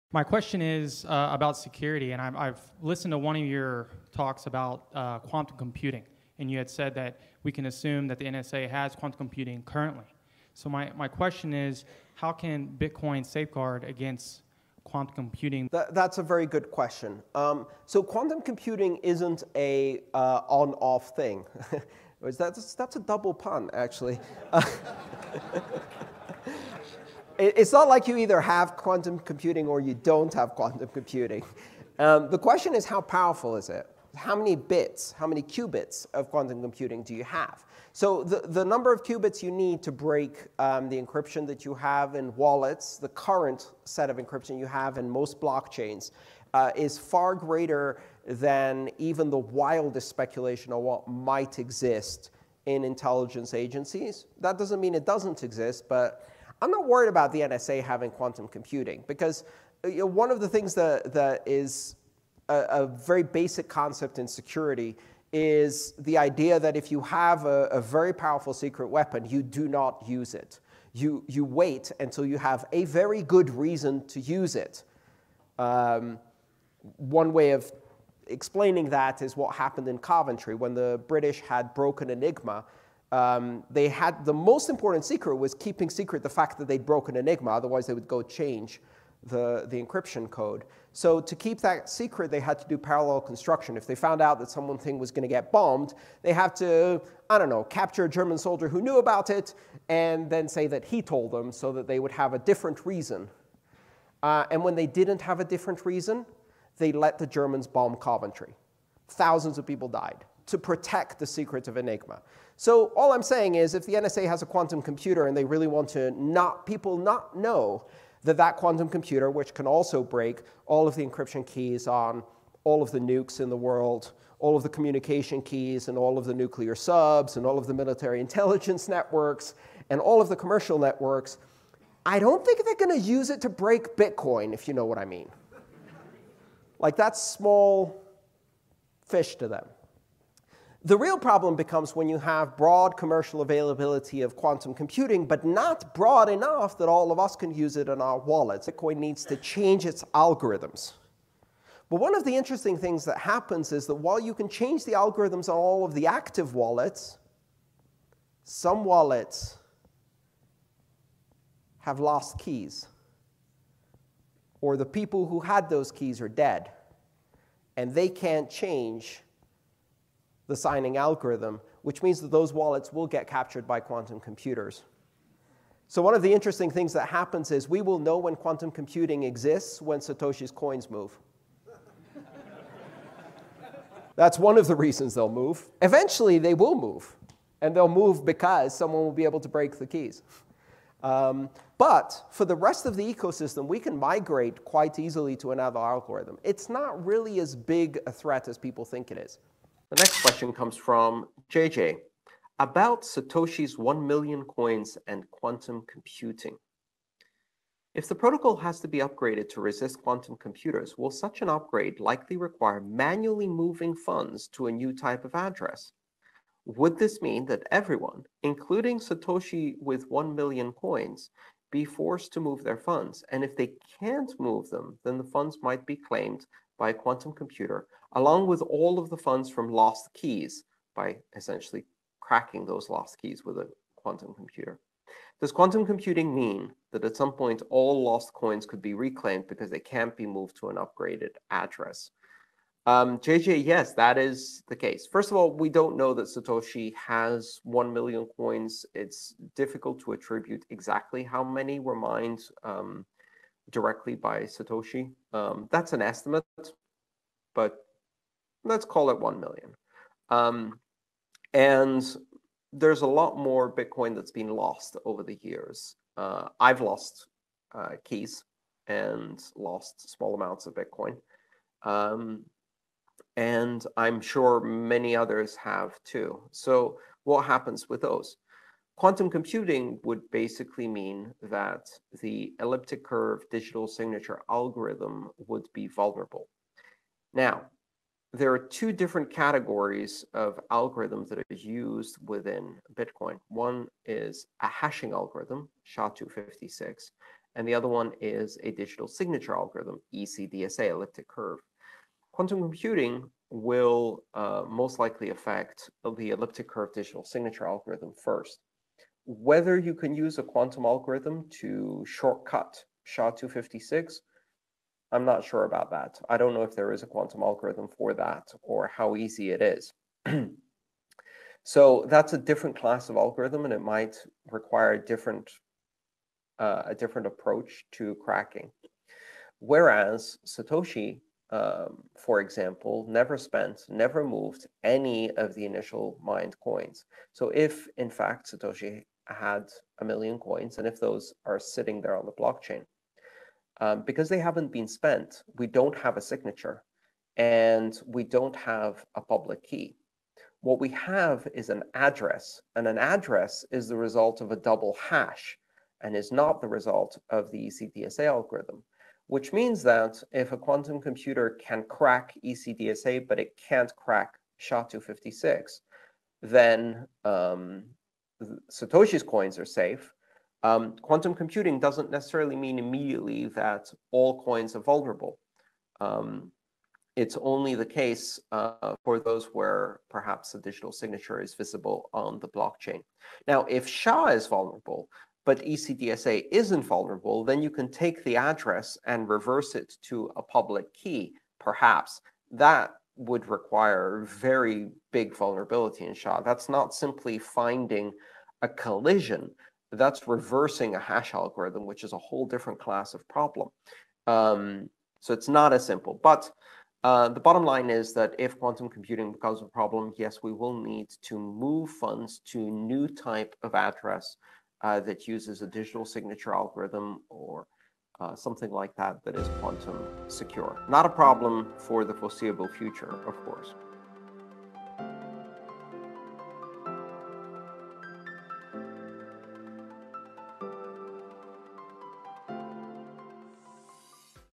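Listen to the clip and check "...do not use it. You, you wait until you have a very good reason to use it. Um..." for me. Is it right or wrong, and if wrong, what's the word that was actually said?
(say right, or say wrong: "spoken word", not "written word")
right.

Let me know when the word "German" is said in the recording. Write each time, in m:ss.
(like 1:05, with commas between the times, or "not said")
1:38, 1:47.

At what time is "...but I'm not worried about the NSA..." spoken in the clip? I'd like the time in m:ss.
0:55.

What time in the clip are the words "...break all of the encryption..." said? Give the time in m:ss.
2:00.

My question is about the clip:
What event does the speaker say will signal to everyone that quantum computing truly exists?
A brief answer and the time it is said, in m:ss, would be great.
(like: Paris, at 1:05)
Satoshi's coins move, at 2:59.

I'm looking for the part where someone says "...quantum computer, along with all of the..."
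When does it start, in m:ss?
3:46.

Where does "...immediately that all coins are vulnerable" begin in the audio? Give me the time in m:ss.
6:12.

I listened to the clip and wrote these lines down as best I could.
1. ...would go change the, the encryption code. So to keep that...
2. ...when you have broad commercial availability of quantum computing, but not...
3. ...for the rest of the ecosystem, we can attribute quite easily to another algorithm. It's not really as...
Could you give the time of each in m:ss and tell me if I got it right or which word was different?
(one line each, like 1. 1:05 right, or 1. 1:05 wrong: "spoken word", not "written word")
1. 1:27 right
2. 2:21 right
3. 3:12 wrong: "migrate", not "attribute".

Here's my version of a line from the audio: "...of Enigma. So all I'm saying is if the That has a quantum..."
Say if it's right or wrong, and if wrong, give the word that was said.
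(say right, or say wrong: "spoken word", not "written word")
wrong: "NSA", not "That".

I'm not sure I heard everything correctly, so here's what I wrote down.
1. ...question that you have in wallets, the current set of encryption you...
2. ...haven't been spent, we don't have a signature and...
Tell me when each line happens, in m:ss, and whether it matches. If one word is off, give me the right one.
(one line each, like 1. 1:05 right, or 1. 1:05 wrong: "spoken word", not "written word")
1. 0:41 wrong: "encryption", not "question"
2. 5:44 right.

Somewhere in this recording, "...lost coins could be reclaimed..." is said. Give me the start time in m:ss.
3:58.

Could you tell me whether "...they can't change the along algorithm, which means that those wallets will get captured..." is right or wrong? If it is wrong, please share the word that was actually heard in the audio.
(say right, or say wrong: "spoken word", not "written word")
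wrong: "signing", not "along".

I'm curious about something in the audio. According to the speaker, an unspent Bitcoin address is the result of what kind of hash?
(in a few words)
a double hash.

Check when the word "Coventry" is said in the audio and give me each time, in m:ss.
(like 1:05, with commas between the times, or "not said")
1:19, 1:47.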